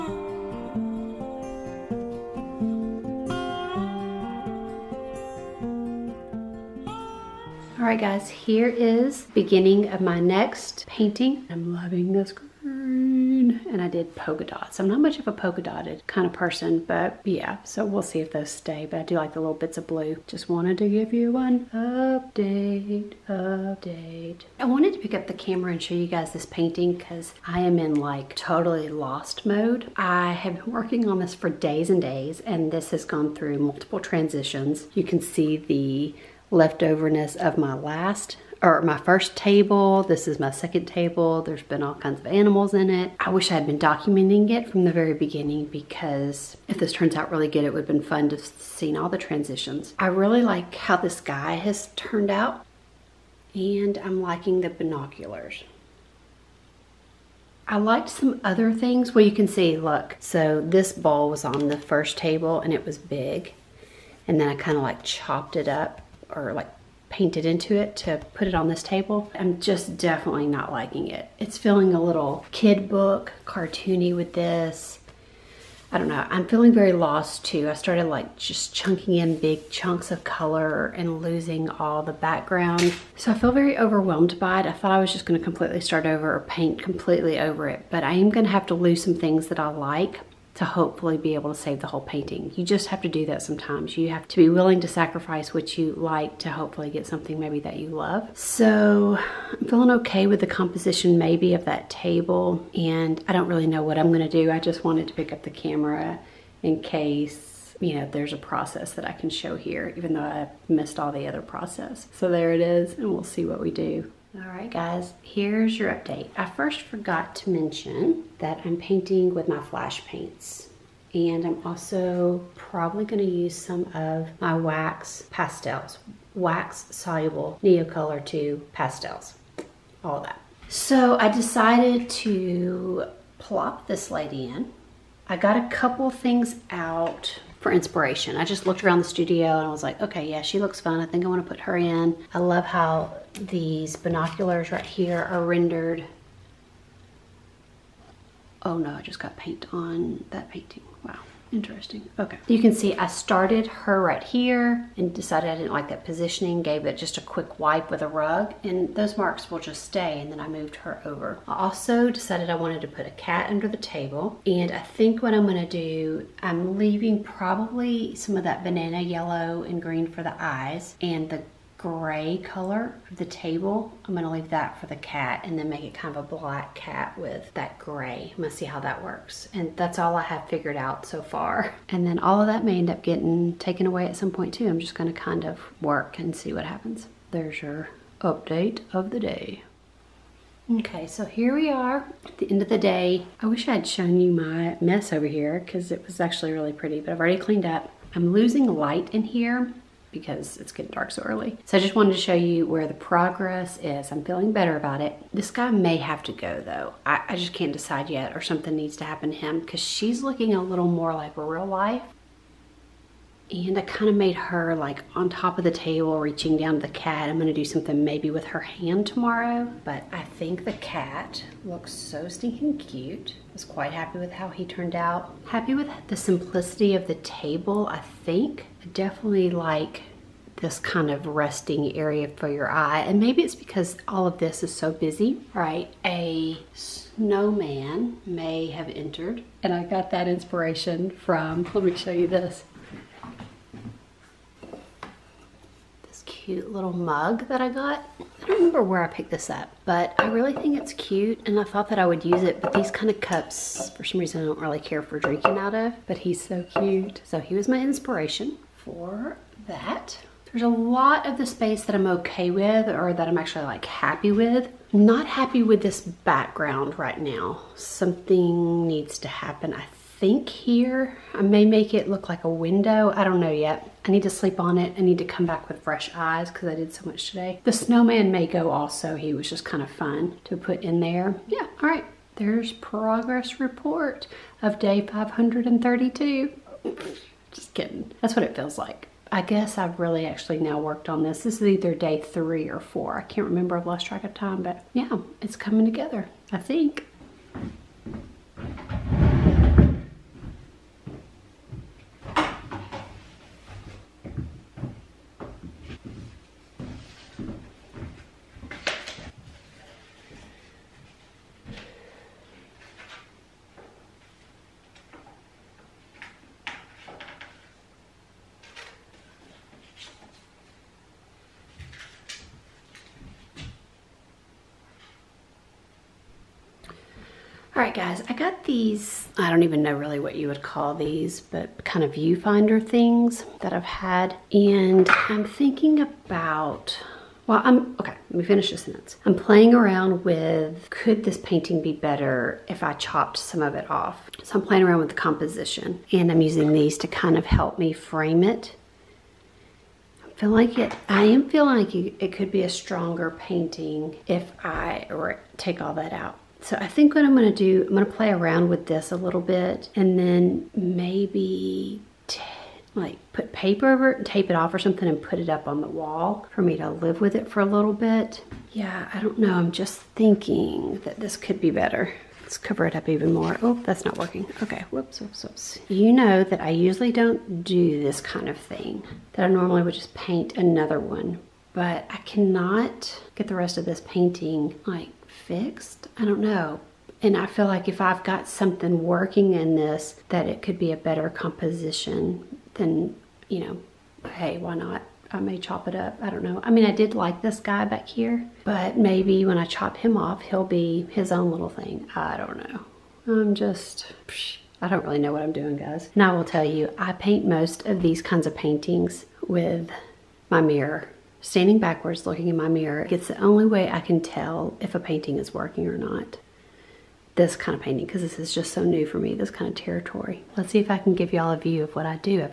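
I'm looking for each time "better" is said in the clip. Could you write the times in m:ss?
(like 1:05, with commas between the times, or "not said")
3:24, 5:41, 6:11, 6:30.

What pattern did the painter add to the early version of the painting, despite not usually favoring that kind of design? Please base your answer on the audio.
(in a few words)
Polka dots.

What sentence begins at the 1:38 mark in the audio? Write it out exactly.
So I'm feeling okay with the composition maybe of that table and I don't really know what I'm gonna do.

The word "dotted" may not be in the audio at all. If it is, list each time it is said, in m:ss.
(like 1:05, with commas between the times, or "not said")
0:15.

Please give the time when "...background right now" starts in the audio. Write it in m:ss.
4:26.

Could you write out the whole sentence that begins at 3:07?
There's your update of the day.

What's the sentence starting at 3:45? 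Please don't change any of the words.
Happy with the simplicity of the table, I think definitely like this kind of resting area for your eye.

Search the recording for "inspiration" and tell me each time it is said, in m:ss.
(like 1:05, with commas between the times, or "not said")
2:17, 4:00, 4:17.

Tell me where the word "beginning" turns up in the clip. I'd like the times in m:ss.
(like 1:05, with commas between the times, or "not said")
0:09, 0:45.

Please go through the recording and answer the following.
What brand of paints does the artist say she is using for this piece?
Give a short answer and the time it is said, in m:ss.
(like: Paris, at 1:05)
Flashe, at 1:59.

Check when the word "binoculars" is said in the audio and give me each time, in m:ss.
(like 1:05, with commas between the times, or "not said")
0:54, 2:23.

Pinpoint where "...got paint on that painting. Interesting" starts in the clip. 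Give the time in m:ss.
2:29.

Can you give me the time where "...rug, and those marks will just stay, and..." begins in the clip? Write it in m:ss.
2:38.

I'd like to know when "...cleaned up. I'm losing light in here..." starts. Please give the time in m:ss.
3:17.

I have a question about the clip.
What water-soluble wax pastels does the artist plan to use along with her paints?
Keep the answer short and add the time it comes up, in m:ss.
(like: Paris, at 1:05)
Neocolor 2, at 2:07.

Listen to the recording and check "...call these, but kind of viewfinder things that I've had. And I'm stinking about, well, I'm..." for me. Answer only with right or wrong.
wrong.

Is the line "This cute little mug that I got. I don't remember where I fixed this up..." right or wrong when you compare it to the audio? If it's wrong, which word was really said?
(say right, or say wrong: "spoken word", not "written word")
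wrong: "picked", not "fixed".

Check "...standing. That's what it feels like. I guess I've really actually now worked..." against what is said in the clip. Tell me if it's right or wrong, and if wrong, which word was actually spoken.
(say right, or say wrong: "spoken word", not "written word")
wrong: "kidding", not "standing".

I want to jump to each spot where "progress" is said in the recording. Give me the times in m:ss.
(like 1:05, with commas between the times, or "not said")
3:22, 4:42.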